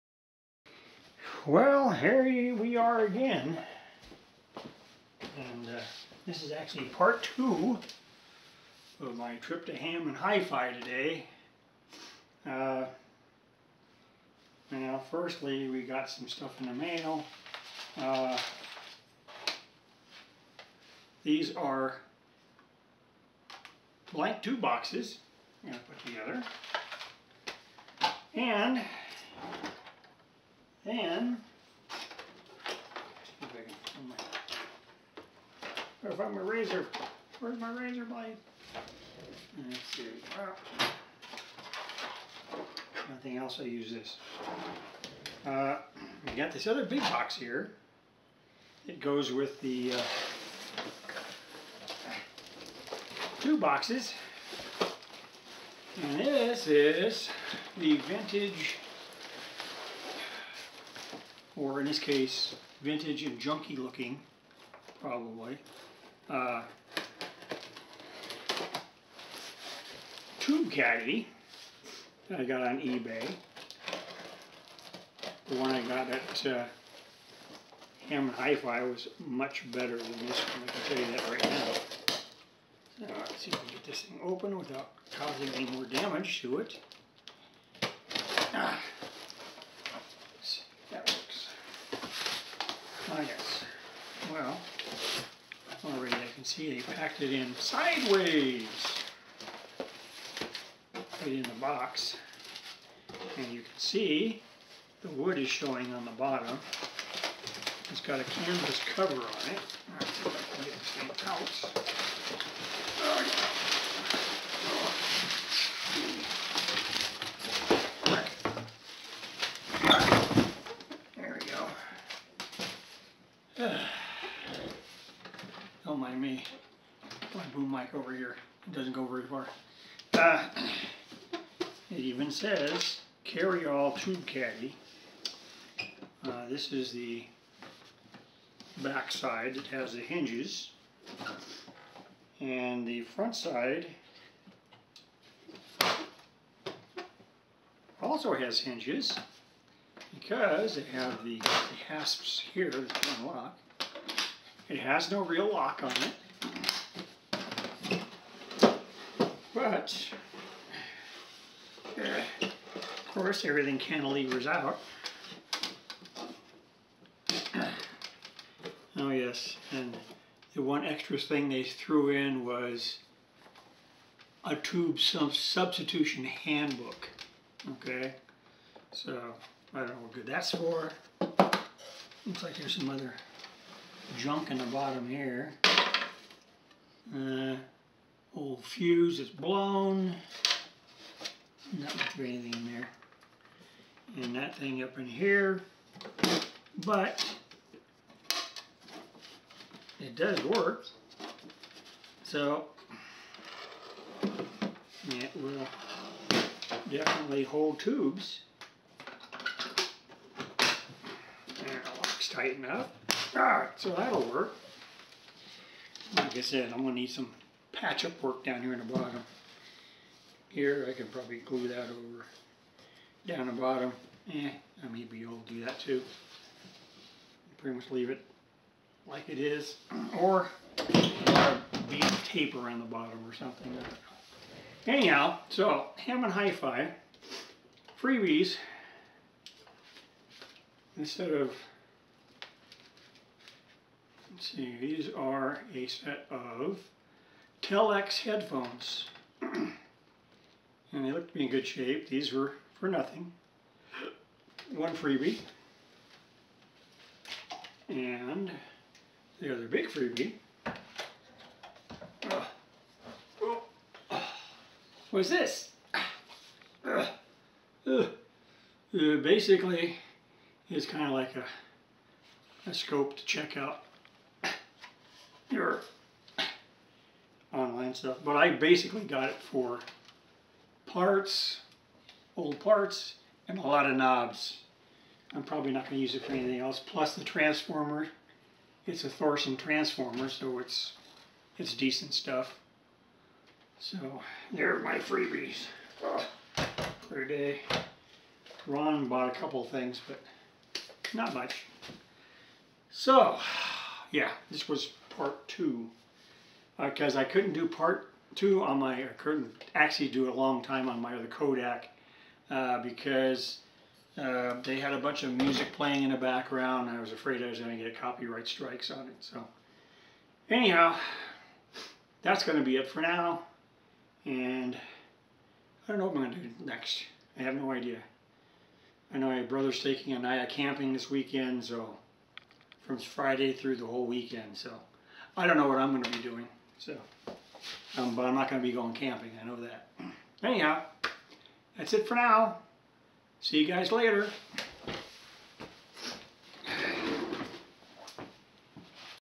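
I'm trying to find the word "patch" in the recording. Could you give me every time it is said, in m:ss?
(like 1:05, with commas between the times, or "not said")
3:37.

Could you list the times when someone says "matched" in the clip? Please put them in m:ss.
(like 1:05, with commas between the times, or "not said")
not said.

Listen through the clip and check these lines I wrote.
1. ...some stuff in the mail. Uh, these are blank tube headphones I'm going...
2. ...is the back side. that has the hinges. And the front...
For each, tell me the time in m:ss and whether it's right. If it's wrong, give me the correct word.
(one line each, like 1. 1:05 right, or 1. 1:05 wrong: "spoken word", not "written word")
1. 0:16 wrong: "boxes", not "headphones"
2. 2:16 right.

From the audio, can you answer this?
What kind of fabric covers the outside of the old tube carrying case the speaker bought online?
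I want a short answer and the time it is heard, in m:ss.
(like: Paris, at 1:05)
Canvas, at 1:48.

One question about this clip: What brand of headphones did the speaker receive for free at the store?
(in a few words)
LX.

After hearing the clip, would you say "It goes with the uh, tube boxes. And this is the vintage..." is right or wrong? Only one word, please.
right.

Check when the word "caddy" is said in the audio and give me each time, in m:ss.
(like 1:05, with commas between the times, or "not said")
1:10, 2:14.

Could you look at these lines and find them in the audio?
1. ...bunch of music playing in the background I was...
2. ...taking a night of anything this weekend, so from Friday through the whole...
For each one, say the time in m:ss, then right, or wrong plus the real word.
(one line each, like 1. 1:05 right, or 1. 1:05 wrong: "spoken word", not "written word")
1. 5:14 right
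2. 5:29 wrong: "camping", not "anything".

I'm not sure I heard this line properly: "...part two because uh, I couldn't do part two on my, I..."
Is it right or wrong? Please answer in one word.
right.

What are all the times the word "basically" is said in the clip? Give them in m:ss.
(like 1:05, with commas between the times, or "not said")
4:28, 4:38.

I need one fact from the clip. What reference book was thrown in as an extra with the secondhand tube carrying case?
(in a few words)
Tube substitution handbook.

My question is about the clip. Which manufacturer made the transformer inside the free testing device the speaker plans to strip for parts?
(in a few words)
Thordarson.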